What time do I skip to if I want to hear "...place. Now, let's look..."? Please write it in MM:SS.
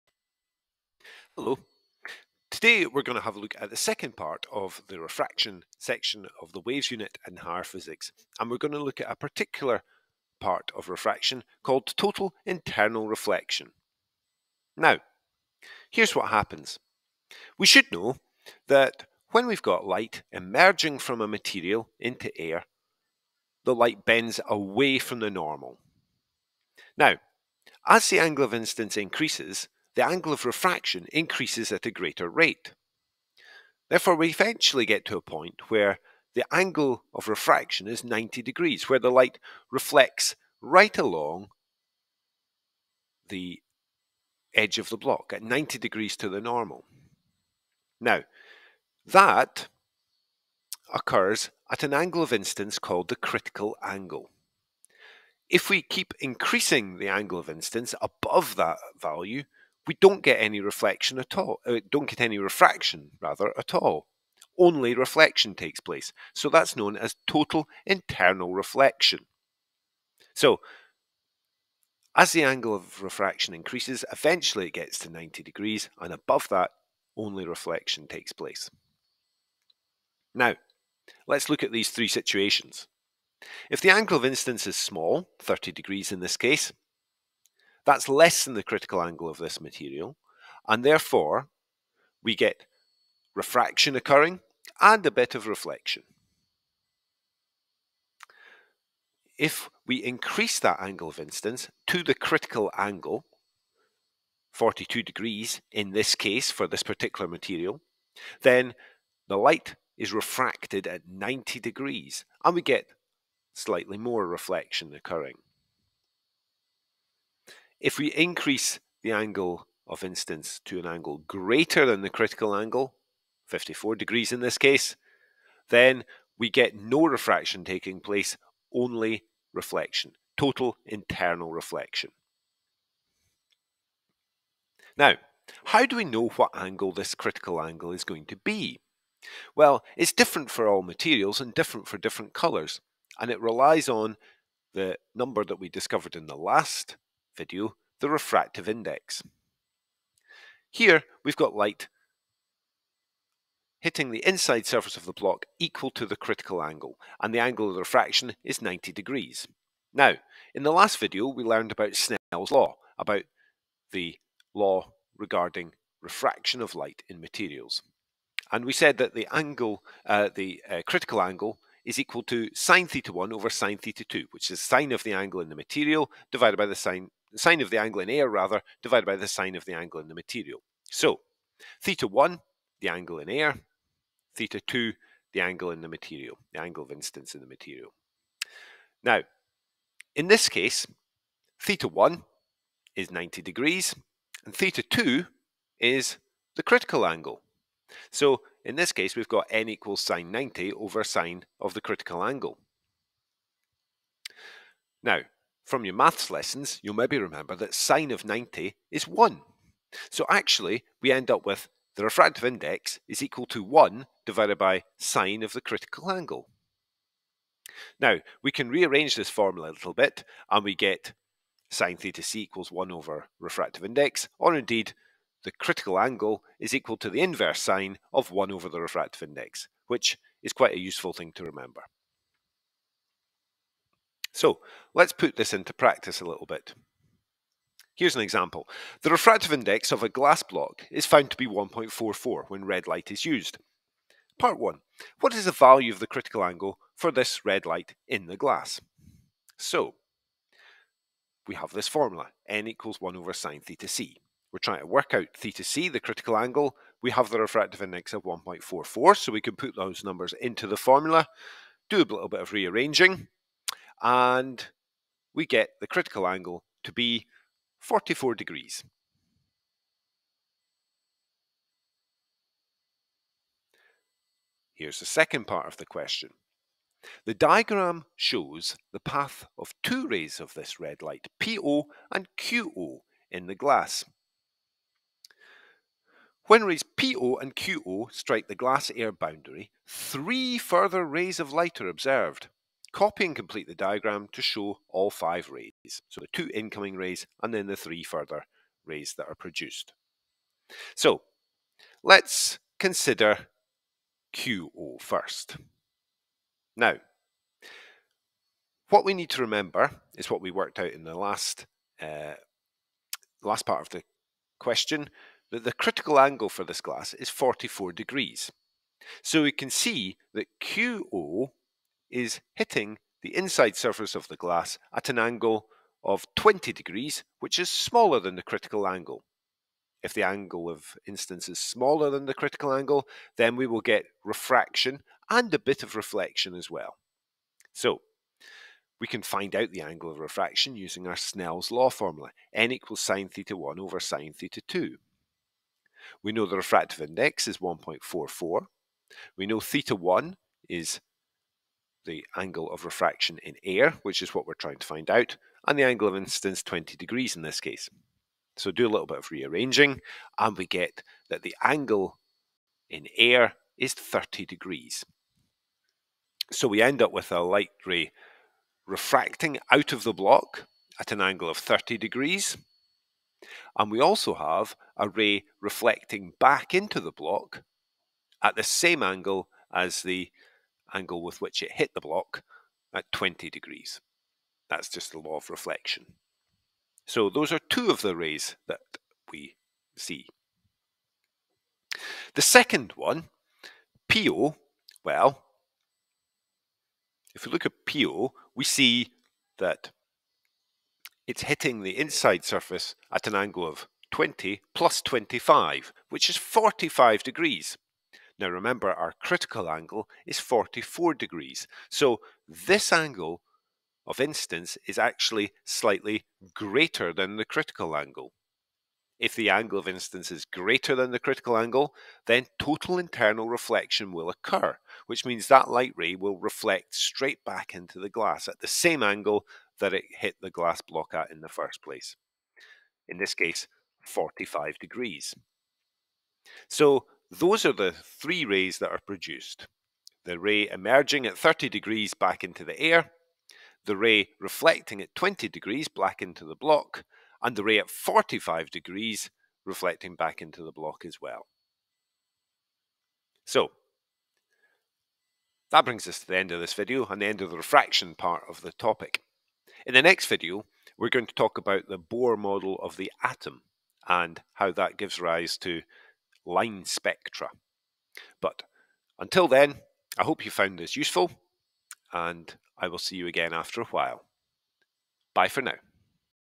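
01:18.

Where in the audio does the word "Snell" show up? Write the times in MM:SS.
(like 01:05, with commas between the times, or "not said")
02:41, 05:41.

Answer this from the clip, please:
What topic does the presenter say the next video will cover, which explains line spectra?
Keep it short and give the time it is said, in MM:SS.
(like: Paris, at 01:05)
Bohr model of the atom, at 07:41.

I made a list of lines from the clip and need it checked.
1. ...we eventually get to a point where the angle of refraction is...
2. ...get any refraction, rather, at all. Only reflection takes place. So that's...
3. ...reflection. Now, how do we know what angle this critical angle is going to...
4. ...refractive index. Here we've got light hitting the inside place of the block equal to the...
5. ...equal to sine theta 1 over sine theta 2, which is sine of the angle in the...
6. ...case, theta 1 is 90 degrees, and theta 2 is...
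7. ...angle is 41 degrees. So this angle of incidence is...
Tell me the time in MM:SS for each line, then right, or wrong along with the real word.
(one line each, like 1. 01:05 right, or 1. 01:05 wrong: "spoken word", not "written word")
1. 00:34 right
2. 01:02 right
3. 02:11 right
4. 02:28 wrong: "surface", not "place"
5. 02:51 right
6. 03:10 right
7. 06:49 wrong: "44", not "41".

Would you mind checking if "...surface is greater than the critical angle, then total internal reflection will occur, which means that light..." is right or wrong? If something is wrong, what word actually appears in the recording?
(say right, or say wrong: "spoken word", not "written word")
wrong: "incidence", not "surface".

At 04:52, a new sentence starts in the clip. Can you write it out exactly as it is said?
Copy and complete the diagram to show all five rays.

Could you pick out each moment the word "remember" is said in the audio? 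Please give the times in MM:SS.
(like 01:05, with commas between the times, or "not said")
03:27, 03:51, 05:09, 06:48.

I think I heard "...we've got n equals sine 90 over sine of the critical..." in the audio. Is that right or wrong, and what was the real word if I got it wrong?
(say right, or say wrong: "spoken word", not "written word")
right.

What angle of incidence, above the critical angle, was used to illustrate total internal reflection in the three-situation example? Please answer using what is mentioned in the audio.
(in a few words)
54 degrees.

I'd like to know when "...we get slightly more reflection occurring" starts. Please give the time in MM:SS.
01:52.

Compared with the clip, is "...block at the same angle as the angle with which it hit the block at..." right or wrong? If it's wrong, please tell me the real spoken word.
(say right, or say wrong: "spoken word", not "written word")
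right.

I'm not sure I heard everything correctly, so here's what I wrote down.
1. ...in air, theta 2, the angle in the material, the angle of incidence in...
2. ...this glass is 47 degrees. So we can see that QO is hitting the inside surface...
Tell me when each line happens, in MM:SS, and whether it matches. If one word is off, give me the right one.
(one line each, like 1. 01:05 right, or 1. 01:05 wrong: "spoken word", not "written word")
1. 03:03 right
2. 05:16 wrong: "44", not "47".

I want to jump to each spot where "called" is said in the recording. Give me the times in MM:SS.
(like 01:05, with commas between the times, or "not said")
00:11, 00:52.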